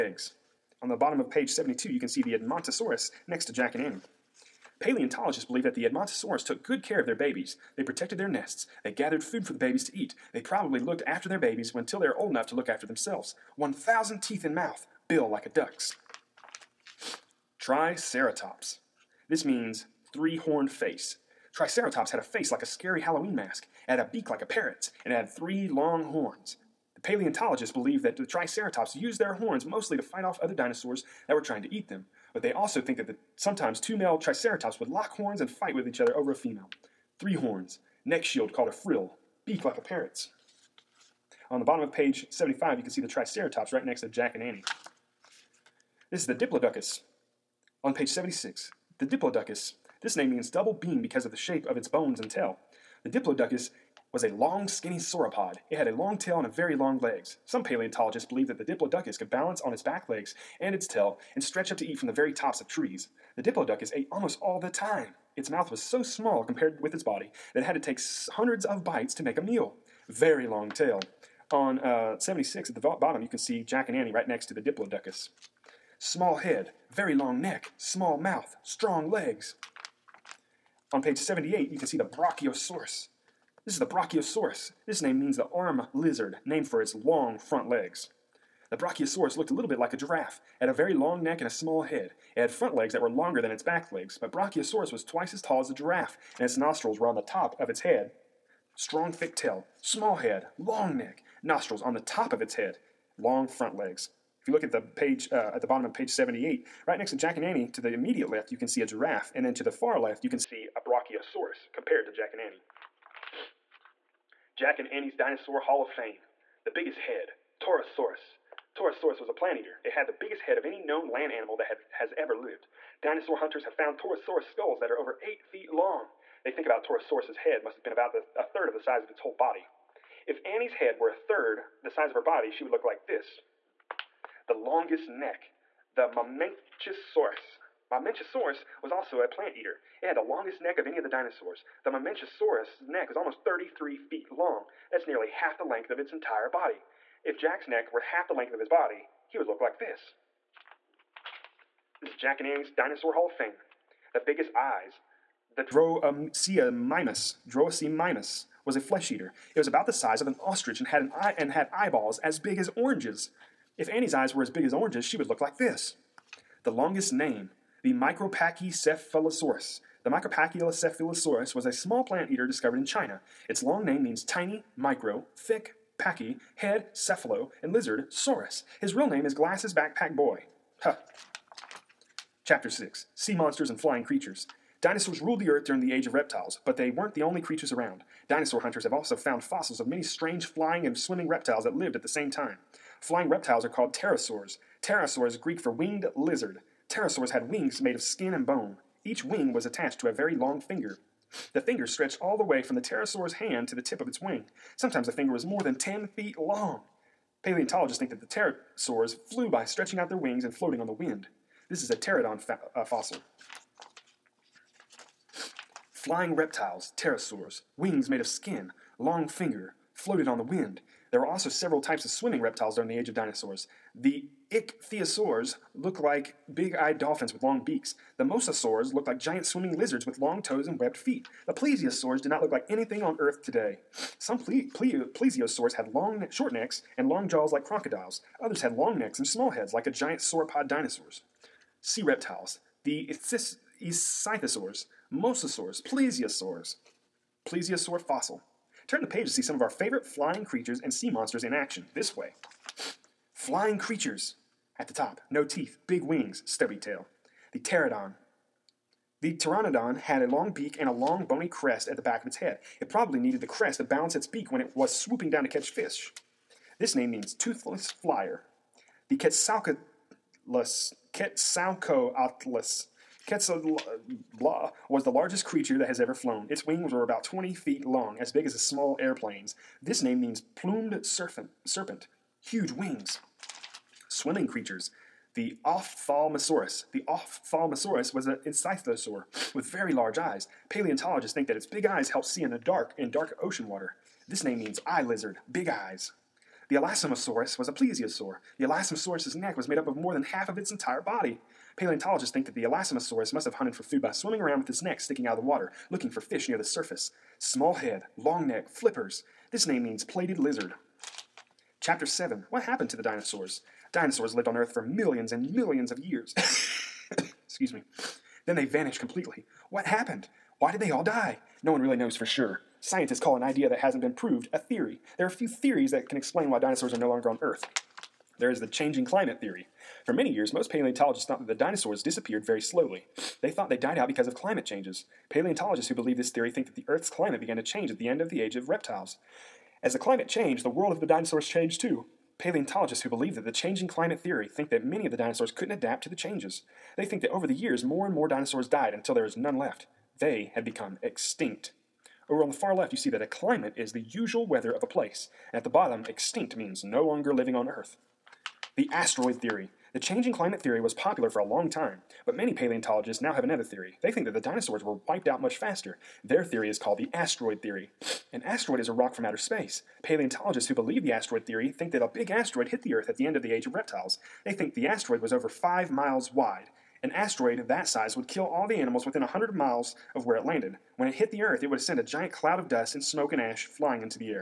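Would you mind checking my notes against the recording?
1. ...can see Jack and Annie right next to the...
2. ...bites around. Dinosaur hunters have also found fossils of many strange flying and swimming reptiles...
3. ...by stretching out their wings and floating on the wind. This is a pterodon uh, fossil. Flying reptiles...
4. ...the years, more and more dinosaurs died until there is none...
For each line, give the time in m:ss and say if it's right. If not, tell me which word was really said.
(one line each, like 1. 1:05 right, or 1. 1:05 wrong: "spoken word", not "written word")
1. 1:13 right
2. 3:07 wrong: "creatures", not "bites"
3. 3:29 right
4. 5:47 right.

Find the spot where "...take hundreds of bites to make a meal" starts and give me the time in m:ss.
1:07.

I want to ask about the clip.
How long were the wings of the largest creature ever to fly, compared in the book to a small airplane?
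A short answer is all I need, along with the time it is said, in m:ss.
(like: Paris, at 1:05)
about 20 feet, at 4:37.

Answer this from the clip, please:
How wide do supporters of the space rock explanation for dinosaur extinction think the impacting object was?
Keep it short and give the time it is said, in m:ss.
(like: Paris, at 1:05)
over five miles, at 6:15.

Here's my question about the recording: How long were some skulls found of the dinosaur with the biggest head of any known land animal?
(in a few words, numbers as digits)
over eight feet.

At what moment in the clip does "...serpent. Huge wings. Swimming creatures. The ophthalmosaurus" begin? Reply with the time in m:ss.
4:41.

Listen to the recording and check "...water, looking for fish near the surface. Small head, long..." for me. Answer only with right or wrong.
right.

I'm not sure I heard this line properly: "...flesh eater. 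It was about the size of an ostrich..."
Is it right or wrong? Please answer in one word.
right.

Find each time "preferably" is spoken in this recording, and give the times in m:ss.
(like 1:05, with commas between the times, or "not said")
not said.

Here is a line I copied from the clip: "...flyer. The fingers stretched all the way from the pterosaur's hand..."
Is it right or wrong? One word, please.
wrong.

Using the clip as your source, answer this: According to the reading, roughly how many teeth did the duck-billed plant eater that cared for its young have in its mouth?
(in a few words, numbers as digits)
1,000.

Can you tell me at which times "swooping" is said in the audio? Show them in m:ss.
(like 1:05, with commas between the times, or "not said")
4:24.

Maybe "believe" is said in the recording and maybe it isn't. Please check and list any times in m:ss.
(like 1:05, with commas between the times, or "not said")
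0:05, 0:27, 0:58, 5:35, 5:43, 6:10.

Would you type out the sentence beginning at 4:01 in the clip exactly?
Sea reptiles, the ichthys- ichthyosaurs, mosasaurs, plesiosaurs, plesiosaur fossil.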